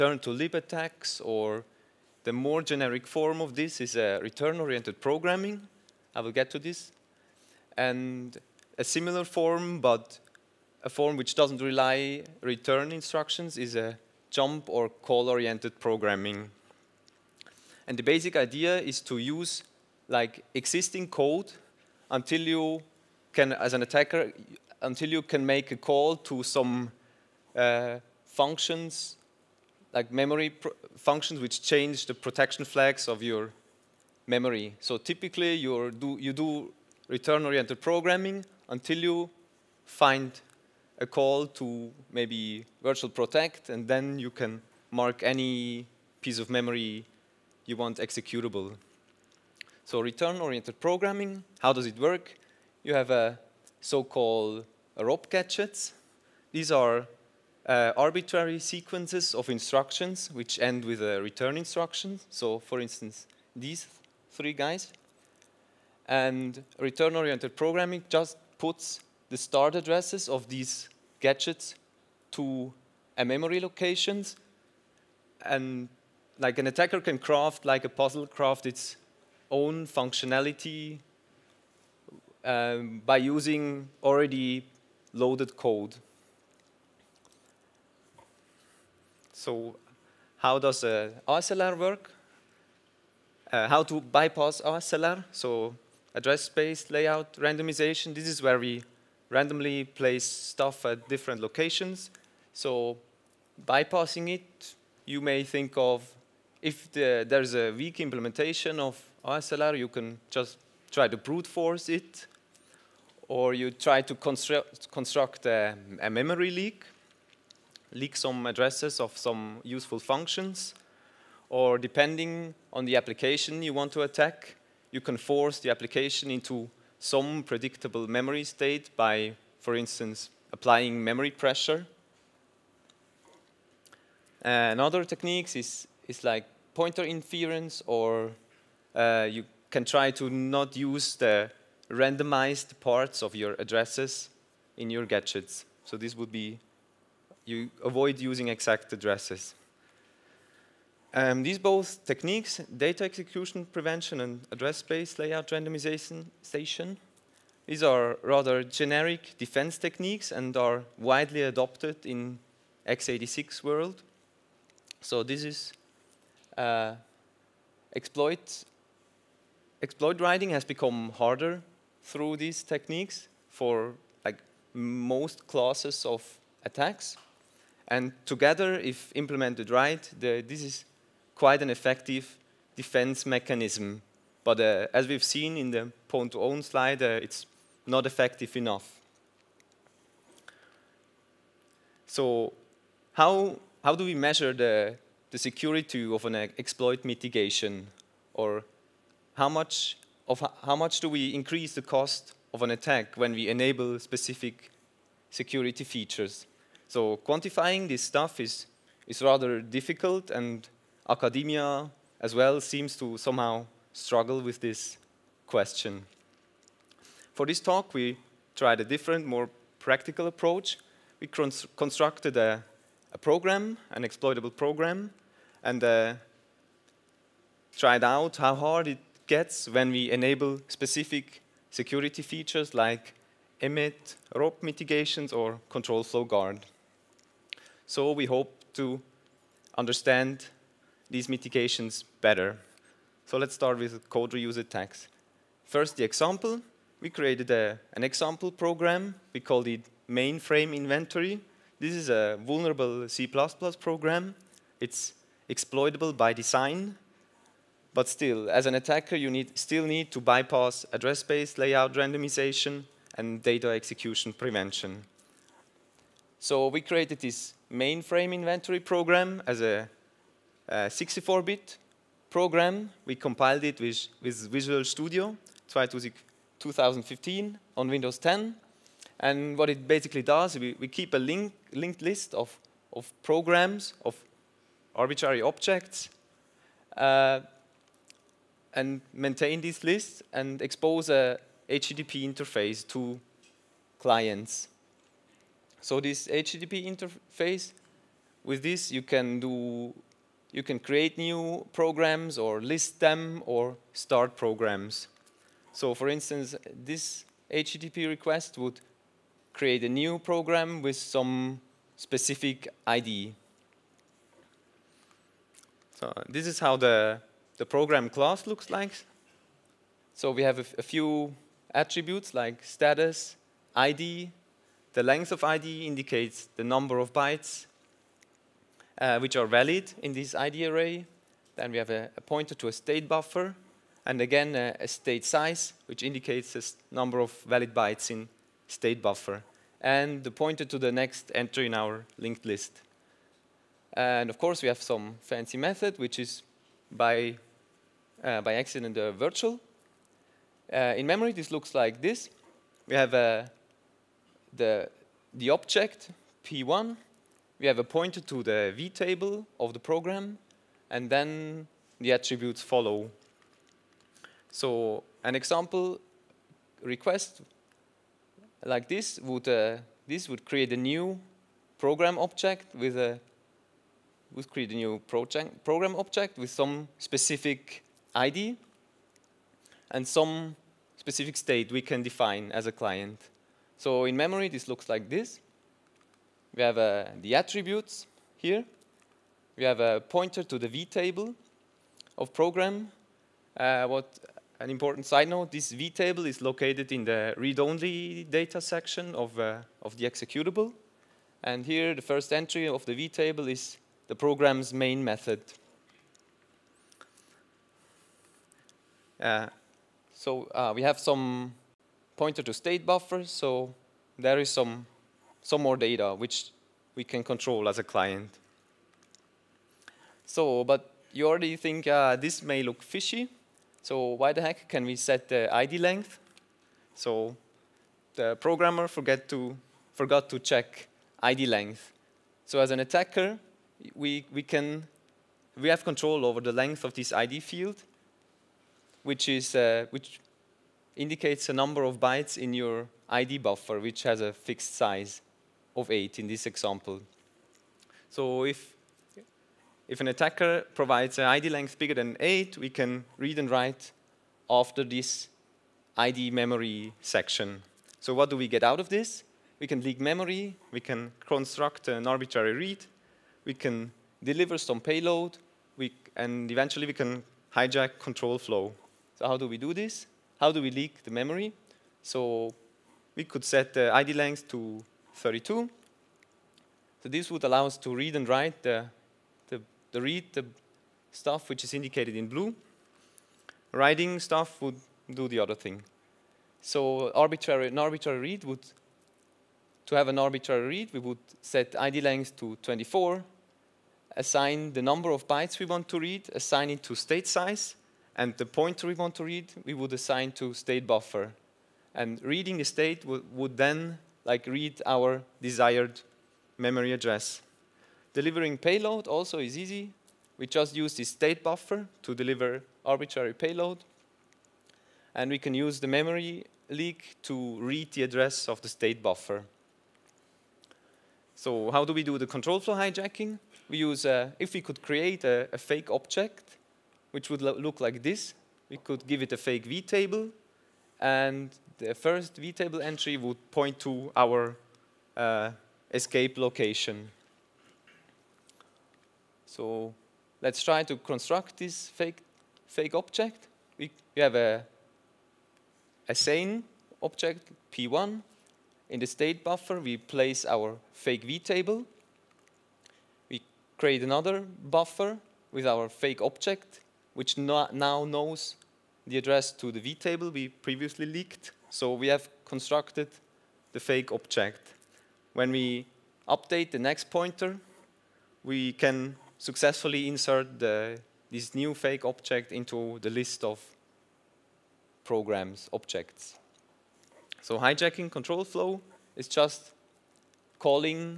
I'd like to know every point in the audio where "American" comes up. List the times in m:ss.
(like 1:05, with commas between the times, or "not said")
not said.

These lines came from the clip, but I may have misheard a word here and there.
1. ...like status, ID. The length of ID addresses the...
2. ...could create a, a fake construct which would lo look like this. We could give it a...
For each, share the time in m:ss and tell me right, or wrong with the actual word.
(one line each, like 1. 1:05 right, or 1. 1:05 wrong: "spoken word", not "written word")
1. 5:22 wrong: "indicates", not "addresses"
2. 8:44 wrong: "object", not "construct".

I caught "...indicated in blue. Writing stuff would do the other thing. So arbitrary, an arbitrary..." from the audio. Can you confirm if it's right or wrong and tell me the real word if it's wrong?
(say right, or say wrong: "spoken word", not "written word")
right.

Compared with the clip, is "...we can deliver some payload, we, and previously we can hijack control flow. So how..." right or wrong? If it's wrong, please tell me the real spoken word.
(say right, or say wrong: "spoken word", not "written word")
wrong: "eventually", not "previously".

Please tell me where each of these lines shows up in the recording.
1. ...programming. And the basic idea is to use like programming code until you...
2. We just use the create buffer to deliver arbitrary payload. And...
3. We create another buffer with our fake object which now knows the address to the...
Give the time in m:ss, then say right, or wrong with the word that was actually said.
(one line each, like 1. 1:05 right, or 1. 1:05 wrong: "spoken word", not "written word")
1. 0:15 wrong: "existing", not "programming"
2. 8:30 wrong: "state", not "create"
3. 9:13 right.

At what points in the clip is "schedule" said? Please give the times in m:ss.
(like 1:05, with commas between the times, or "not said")
not said.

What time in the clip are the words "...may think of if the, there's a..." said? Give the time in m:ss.
1:45.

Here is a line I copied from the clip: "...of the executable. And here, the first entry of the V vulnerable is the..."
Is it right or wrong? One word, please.
wrong.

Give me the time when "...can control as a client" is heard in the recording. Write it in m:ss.
6:57.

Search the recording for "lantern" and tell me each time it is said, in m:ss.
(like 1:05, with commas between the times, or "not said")
not said.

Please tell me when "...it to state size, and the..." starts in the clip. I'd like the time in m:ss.
8:16.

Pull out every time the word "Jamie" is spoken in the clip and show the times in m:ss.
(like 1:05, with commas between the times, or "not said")
not said.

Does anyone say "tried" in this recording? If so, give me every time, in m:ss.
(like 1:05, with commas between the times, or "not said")
3:38, 3:47.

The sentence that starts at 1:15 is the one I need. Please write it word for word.
And like an attacker can craft, like a puzzle craft its own functionality um, by using already loaded code.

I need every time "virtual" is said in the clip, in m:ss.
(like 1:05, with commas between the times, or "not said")
0:42, 5:49.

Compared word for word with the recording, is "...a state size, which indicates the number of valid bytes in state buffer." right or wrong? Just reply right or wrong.
right.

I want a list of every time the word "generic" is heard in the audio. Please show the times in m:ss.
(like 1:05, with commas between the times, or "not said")
0:02, 2:38.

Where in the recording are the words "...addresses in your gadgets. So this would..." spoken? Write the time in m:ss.
2:23.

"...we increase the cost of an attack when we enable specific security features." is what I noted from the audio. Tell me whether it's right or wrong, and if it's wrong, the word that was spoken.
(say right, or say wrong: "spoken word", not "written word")
right.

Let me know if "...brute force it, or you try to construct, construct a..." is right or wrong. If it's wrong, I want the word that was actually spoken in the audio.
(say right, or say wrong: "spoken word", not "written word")
right.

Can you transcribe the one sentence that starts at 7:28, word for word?
So if, if an attacker provides an ID length bigger than 8, we can read and write after this ID memory section.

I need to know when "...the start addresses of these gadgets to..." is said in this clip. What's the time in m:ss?
1:09.